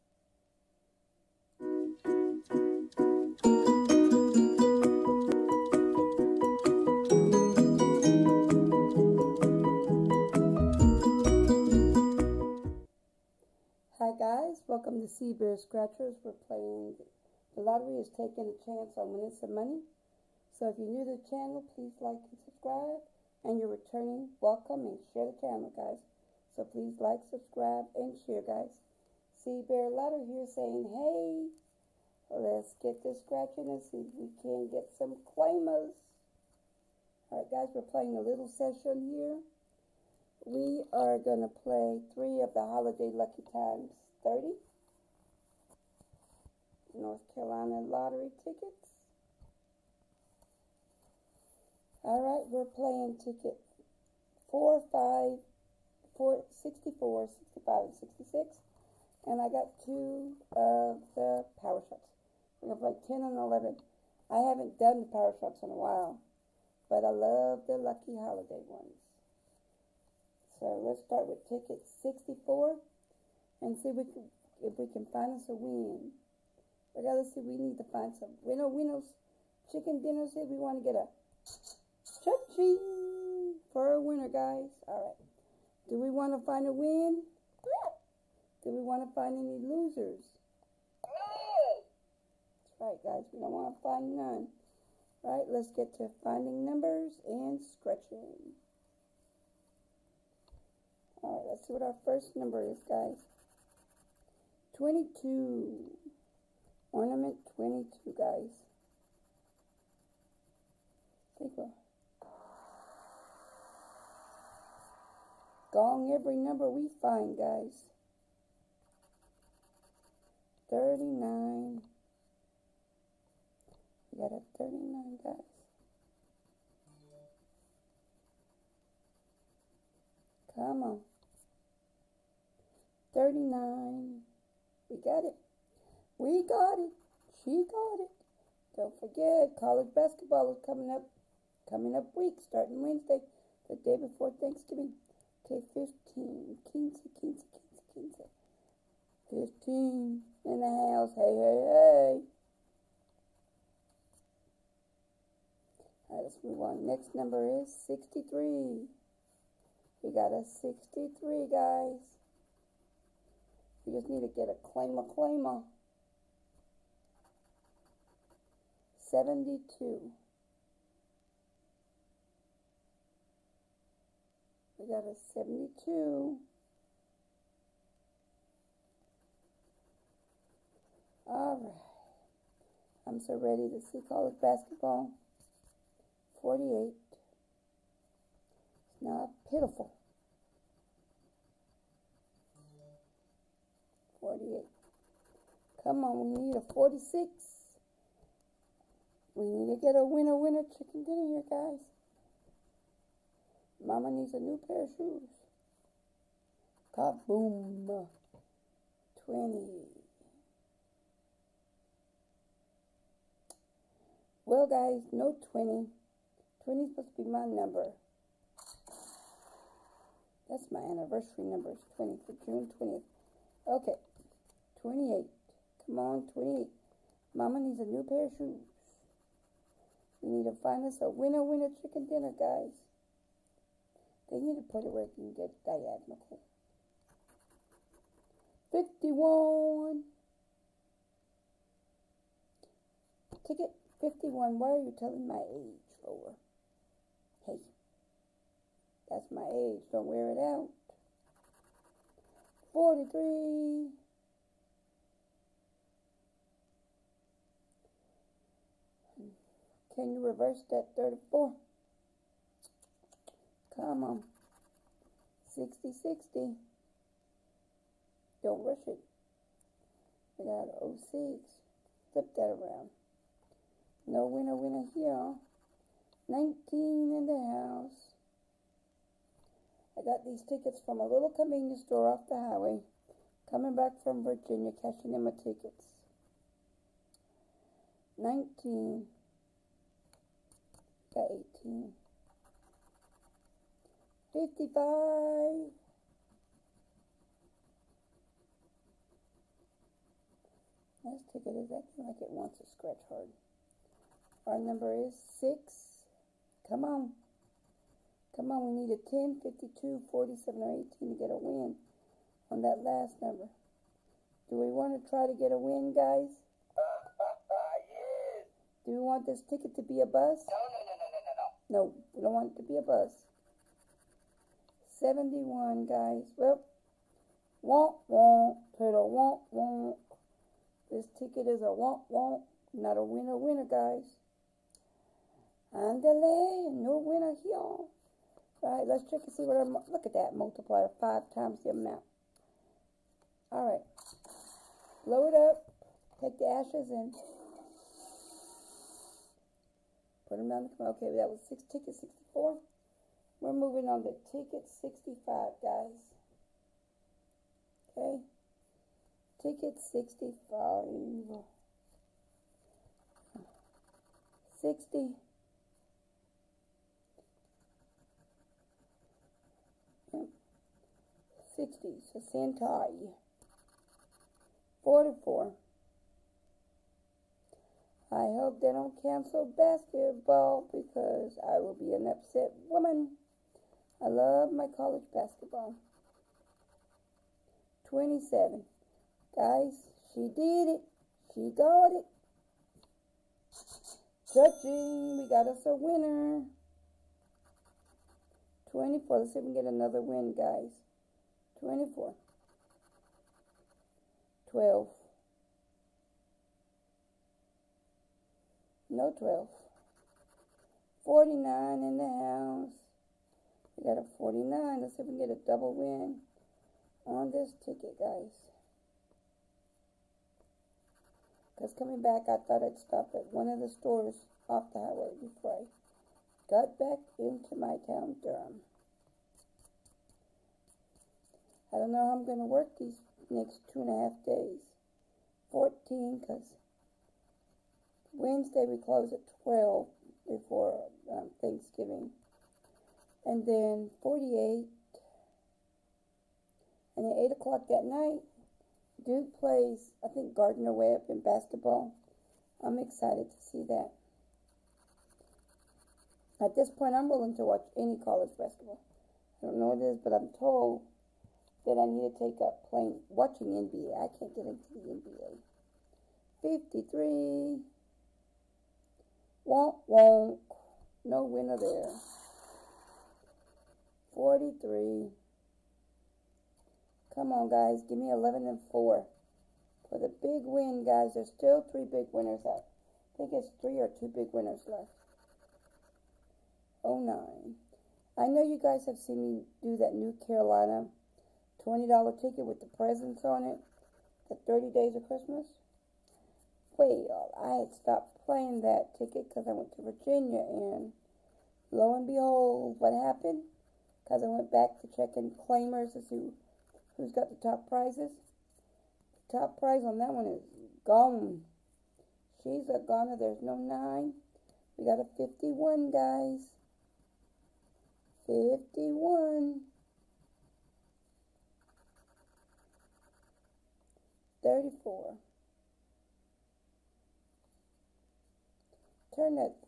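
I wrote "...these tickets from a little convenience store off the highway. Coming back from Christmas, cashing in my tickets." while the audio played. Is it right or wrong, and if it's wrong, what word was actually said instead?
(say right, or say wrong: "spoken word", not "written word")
wrong: "Virginia", not "Christmas".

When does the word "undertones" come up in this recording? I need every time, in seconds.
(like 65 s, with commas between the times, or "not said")
not said.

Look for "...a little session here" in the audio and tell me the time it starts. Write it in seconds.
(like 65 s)
38 s.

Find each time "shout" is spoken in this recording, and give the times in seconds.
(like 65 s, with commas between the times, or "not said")
not said.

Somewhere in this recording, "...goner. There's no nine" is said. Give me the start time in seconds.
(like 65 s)
512 s.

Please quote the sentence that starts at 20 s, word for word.
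So if you're new to the channel, please like and subscribe.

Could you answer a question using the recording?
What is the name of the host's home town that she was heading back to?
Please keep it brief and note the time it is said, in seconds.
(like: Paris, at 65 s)
Durham, at 428 s.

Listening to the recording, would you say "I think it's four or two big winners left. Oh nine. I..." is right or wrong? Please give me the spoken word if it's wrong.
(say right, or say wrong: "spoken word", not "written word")
wrong: "three", not "four".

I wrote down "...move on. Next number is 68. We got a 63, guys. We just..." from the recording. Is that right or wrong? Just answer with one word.
wrong.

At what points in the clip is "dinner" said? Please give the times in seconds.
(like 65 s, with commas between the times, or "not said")
80 s, 201 s, 232 s.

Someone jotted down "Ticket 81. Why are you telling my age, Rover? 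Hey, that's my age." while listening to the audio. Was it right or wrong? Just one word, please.
wrong.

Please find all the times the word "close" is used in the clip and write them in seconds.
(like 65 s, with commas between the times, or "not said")
438 s.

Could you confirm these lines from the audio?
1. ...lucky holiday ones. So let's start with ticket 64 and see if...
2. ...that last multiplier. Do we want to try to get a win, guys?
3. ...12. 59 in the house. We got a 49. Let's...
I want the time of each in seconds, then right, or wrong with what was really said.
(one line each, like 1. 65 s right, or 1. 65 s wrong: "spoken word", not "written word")
1. 67 s right
2. 312 s wrong: "number", not "multiplier"
3. 409 s wrong: "49", not "59".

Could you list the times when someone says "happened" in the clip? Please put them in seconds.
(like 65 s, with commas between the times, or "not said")
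502 s.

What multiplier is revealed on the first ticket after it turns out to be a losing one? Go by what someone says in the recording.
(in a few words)
5 times.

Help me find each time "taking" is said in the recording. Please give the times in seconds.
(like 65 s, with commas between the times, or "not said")
18 s.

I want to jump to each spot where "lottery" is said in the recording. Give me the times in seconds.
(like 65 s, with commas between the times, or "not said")
17 s, 29 s, 47 s.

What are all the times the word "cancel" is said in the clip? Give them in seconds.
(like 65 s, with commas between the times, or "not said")
379 s.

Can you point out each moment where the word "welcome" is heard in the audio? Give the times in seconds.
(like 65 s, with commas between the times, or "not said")
14 s, 24 s.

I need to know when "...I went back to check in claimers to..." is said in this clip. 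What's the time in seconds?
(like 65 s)
504 s.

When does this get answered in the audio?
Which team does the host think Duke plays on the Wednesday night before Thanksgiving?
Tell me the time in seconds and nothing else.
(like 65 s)
450 s.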